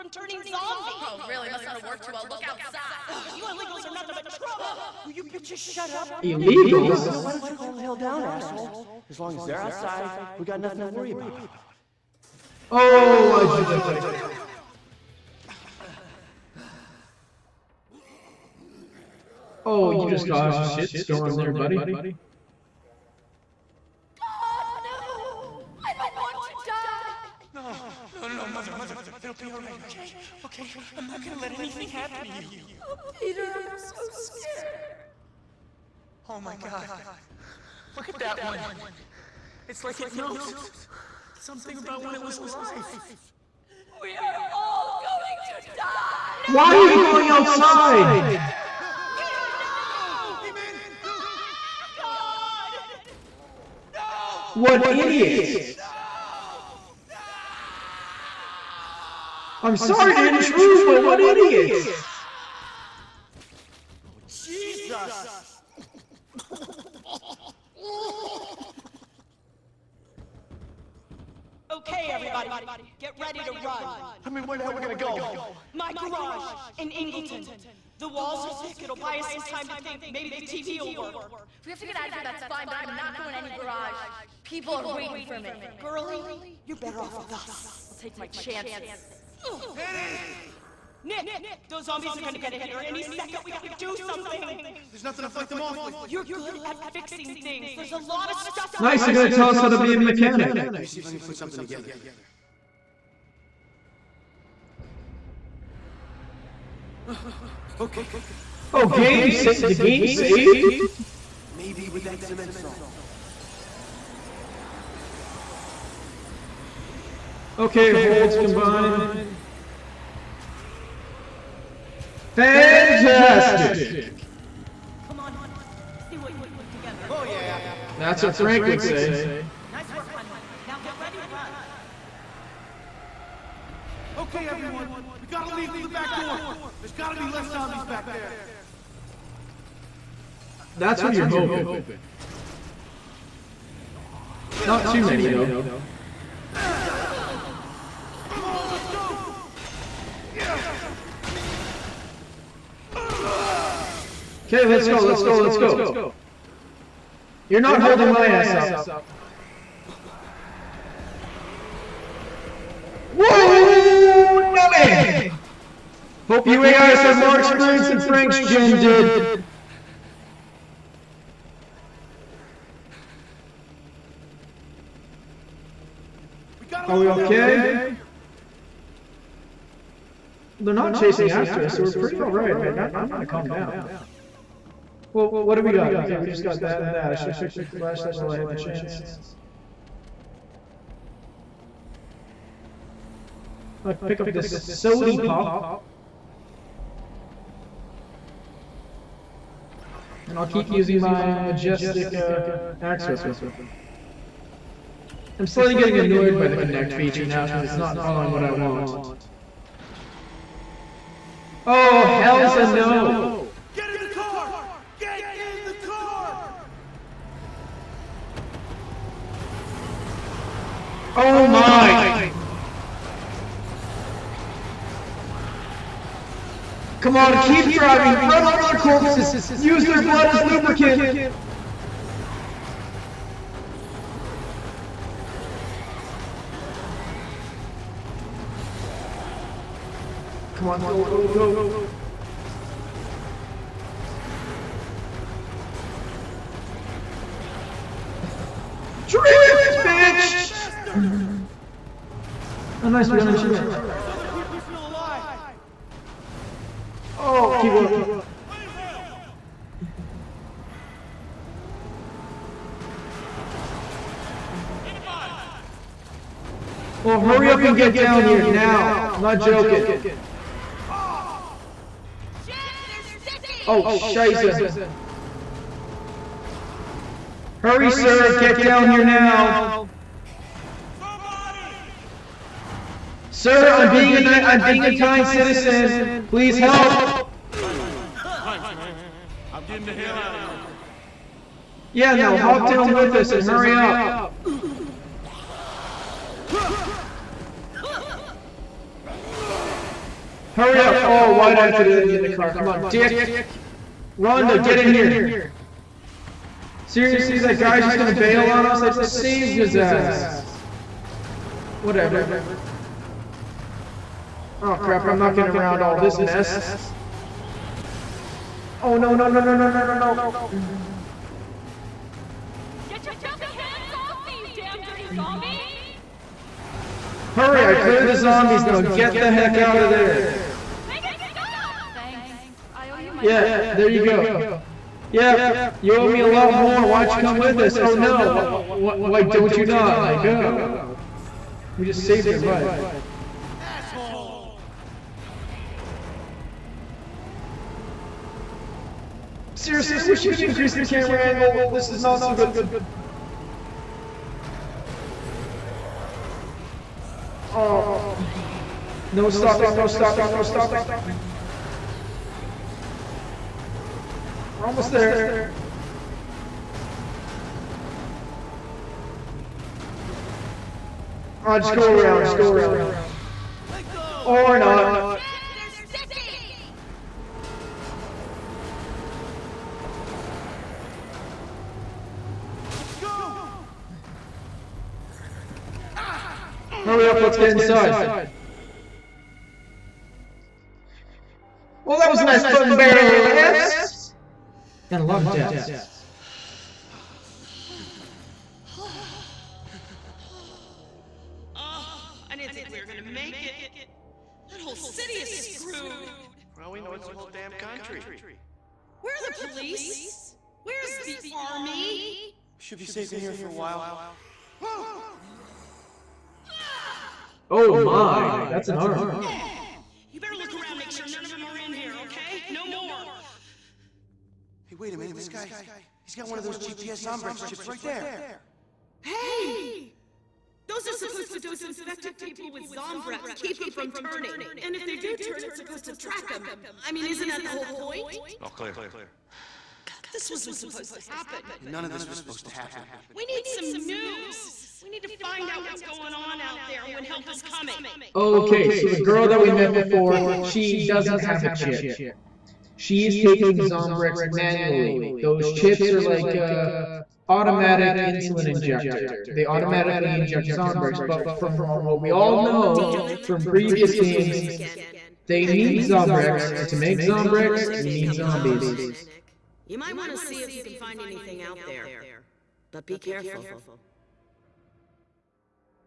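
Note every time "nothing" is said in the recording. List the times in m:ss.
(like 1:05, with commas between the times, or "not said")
0:03, 0:10, 1:35.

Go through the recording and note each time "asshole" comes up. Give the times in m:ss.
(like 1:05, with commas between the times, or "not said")
0:08, 5:43.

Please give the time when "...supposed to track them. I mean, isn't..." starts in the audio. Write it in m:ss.
7:15.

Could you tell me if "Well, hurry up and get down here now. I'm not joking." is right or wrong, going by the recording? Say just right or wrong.
right.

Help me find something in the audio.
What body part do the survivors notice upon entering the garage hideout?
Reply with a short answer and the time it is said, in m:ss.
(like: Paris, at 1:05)
an arm, at 6:58.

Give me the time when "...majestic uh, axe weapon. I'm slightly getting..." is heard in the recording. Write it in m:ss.
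3:21.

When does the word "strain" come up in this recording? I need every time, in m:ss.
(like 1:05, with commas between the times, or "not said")
not said.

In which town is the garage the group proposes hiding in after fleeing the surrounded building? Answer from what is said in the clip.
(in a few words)
Ingleton.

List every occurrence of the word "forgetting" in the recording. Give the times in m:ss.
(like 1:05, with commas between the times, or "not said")
not said.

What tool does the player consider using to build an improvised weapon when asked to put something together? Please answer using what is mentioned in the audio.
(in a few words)
cement saw.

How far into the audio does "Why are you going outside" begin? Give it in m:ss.
0:46.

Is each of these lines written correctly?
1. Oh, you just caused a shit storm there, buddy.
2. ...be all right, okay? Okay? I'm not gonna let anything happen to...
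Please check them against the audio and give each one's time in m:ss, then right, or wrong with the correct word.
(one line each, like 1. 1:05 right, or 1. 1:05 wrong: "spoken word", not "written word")
1. 0:19 right
2. 0:29 right.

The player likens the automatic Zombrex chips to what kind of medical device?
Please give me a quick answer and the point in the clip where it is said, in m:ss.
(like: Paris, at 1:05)
automatic insulin injector, at 7:37.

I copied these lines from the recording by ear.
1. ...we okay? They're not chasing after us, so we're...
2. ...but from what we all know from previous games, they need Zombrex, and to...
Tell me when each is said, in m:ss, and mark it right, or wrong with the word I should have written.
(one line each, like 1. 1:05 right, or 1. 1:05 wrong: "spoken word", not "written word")
1. 2:56 right
2. 7:41 right.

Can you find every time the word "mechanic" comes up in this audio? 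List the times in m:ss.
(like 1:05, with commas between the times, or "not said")
1:39.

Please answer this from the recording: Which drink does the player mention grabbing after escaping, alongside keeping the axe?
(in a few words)
sody pop.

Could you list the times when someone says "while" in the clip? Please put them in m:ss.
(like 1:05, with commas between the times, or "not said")
3:08, 6:53.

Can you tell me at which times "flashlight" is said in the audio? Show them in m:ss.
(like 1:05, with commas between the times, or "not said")
3:07.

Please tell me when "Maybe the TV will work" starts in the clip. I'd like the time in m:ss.
1:20.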